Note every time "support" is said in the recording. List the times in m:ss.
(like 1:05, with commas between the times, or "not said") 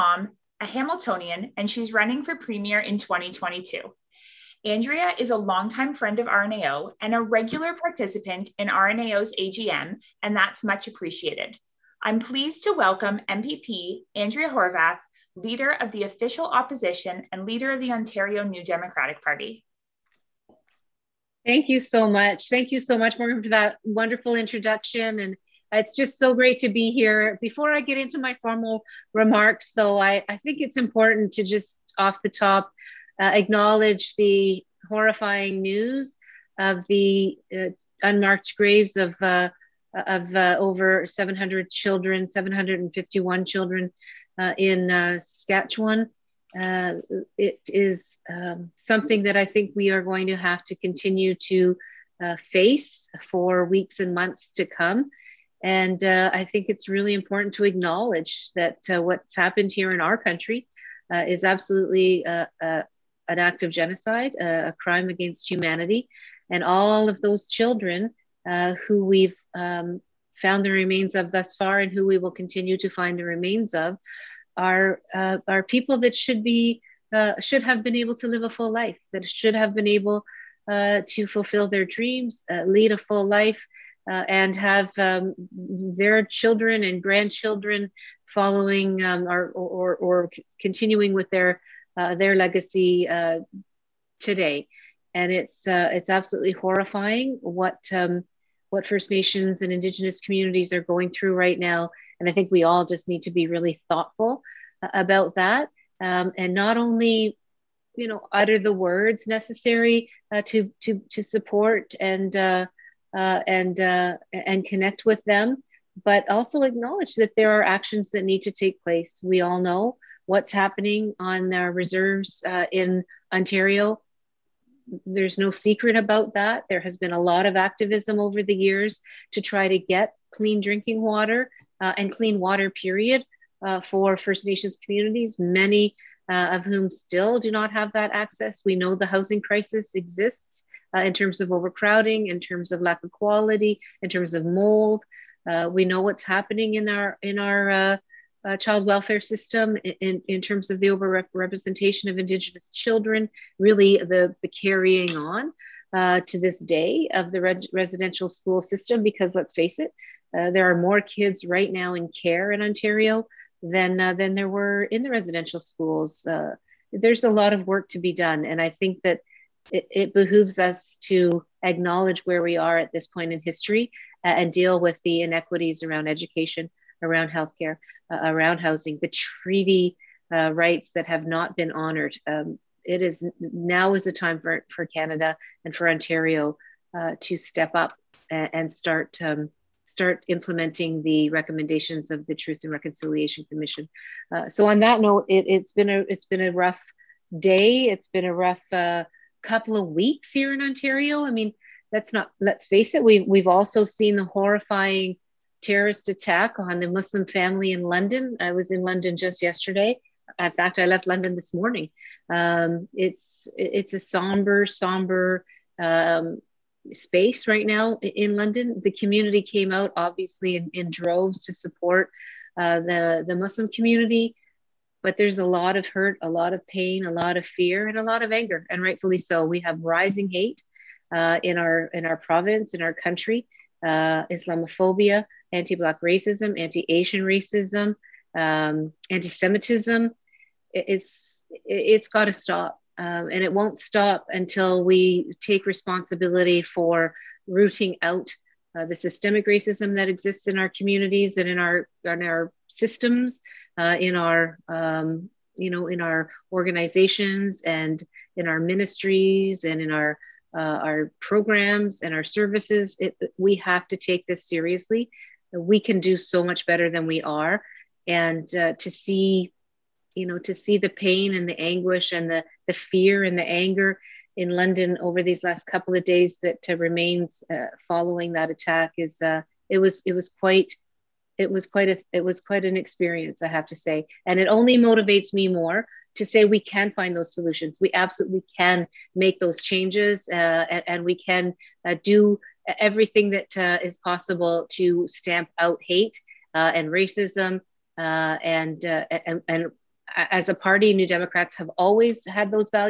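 1:51, 3:41.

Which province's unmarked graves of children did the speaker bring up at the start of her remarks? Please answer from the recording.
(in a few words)
Saskatchewan.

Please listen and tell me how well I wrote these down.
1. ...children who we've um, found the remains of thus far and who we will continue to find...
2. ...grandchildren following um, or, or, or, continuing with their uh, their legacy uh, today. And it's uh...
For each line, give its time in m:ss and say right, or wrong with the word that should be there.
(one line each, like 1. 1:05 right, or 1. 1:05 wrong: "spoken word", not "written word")
1. 1:07 right
2. 1:27 right.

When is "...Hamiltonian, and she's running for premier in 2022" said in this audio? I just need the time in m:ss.
0:00.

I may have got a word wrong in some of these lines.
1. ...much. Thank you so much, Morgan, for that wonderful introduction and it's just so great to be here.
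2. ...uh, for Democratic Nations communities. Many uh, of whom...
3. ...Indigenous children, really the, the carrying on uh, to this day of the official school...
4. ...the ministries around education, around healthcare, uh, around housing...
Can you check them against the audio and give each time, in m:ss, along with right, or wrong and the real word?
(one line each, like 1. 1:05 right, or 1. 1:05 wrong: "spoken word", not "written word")
1. 0:22 right
2. 2:13 wrong: "First", not "Democratic"
3. 2:32 wrong: "residential", not "official"
4. 2:55 wrong: "inequities", not "ministries".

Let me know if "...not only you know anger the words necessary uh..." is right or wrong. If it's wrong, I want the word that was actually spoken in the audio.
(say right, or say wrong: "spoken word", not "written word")
wrong: "utter", not "anger".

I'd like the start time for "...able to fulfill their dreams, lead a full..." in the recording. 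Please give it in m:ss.
1:19.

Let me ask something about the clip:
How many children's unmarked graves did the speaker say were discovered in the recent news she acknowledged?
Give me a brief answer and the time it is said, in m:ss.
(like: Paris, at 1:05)
751, at 0:42.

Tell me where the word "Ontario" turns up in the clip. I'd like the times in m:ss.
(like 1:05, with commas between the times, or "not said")
0:17, 2:03, 2:42, 3:05, 3:20.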